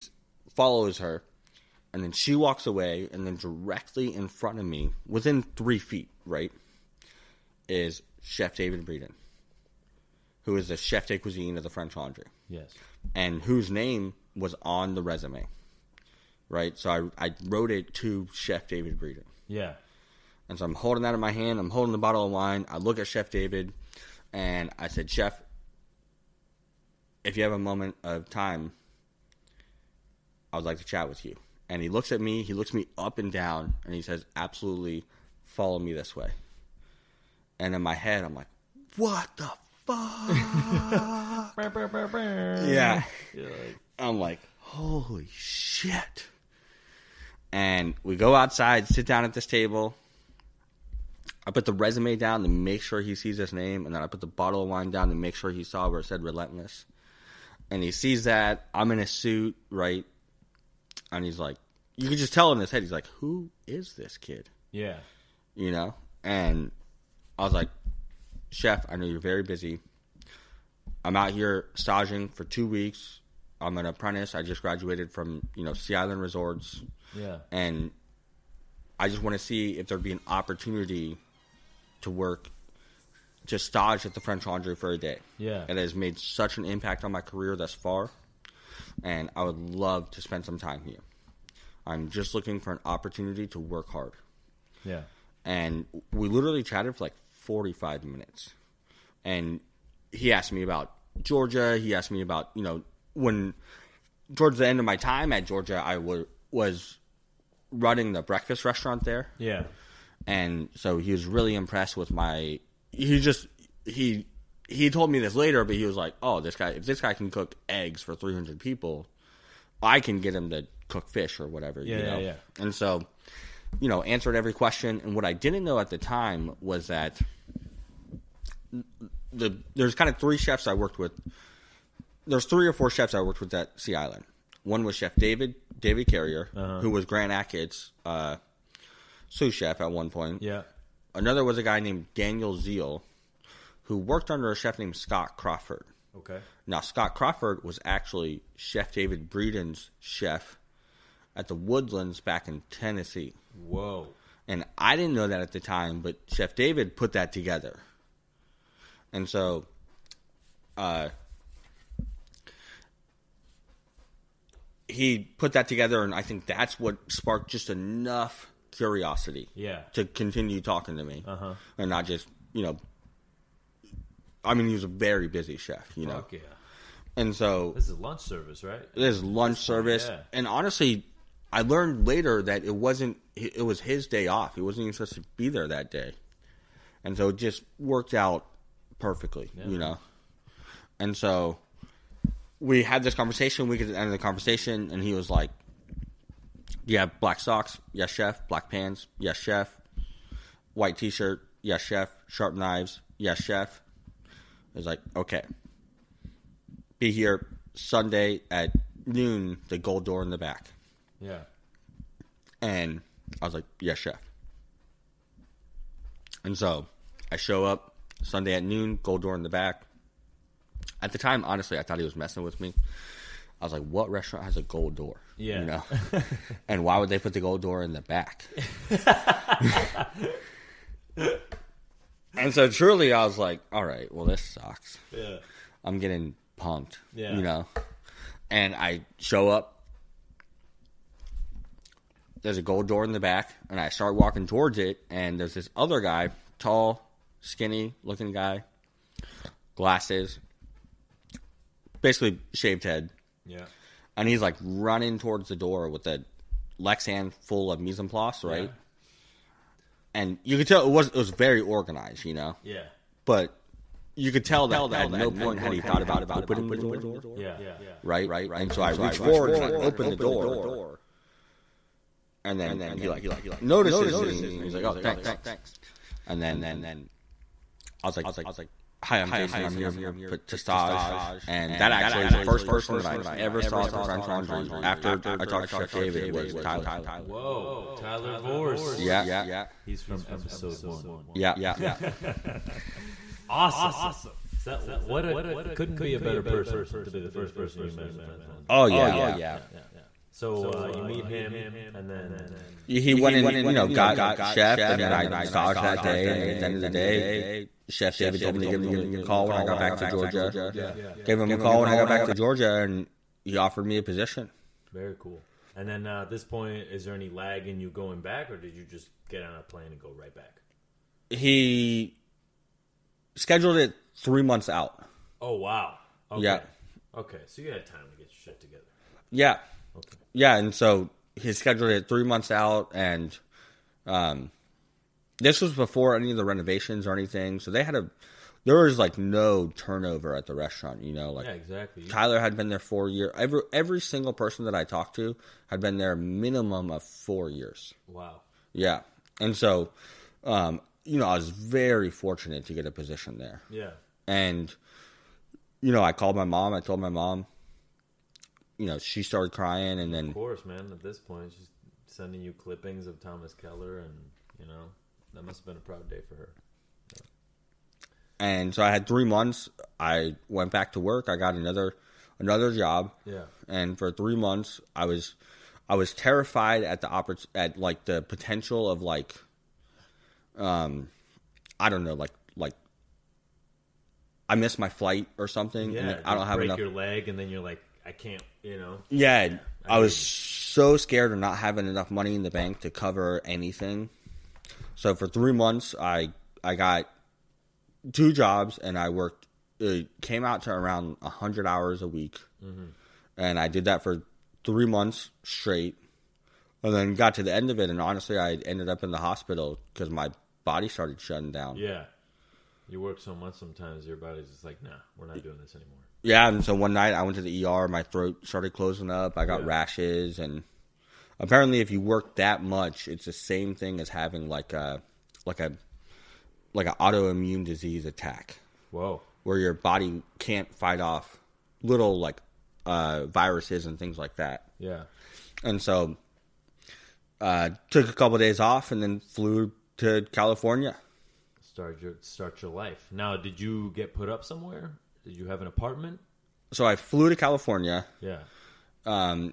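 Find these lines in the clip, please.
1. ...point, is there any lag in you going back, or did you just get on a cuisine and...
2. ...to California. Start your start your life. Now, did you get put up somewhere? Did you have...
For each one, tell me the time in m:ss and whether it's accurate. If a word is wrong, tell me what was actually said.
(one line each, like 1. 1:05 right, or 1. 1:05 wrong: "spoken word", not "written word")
1. 5:16 wrong: "plane", not "cuisine"
2. 7:19 right.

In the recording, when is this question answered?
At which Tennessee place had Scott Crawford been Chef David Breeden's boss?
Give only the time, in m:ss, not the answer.
2:31.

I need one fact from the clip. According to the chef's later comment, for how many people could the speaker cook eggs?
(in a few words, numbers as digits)
300.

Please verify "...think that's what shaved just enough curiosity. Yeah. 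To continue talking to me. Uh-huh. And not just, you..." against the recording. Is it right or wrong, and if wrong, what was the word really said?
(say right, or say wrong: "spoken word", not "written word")
wrong: "sparked", not "shaved".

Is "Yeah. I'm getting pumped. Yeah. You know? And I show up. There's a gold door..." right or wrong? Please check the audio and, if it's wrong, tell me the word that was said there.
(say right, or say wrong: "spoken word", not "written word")
right.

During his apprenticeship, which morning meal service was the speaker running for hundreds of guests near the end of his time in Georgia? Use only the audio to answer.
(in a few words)
Breakfast.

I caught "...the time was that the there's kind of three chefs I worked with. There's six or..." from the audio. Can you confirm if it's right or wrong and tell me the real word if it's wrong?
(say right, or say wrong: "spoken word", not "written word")
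wrong: "three", not "six".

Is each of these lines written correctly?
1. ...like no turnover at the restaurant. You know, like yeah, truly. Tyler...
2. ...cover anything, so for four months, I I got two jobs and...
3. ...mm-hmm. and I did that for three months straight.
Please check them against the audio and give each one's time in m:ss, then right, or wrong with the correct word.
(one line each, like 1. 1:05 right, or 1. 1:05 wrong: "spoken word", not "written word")
1. 5:38 wrong: "exactly", not "truly"
2. 6:32 wrong: "three", not "four"
3. 6:42 right.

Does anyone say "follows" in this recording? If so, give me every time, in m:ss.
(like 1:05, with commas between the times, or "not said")
0:00, 0:35.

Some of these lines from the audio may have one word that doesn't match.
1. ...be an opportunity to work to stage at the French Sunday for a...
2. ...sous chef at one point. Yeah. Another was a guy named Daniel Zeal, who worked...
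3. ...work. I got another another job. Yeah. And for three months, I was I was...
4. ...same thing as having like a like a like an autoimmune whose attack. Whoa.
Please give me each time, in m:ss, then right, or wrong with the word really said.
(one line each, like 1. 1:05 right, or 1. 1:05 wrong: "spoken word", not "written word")
1. 1:20 wrong: "Laundry", not "Sunday"
2. 2:19 right
3. 6:10 right
4. 7:03 wrong: "disease", not "whose".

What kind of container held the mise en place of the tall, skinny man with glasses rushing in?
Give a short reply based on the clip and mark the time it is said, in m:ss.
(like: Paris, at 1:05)
Lexan, at 4:16.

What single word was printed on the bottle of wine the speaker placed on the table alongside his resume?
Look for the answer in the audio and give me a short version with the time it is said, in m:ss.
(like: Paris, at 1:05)
Relentless, at 0:56.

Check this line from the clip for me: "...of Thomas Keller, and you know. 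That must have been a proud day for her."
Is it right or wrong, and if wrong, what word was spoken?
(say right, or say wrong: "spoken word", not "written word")
right.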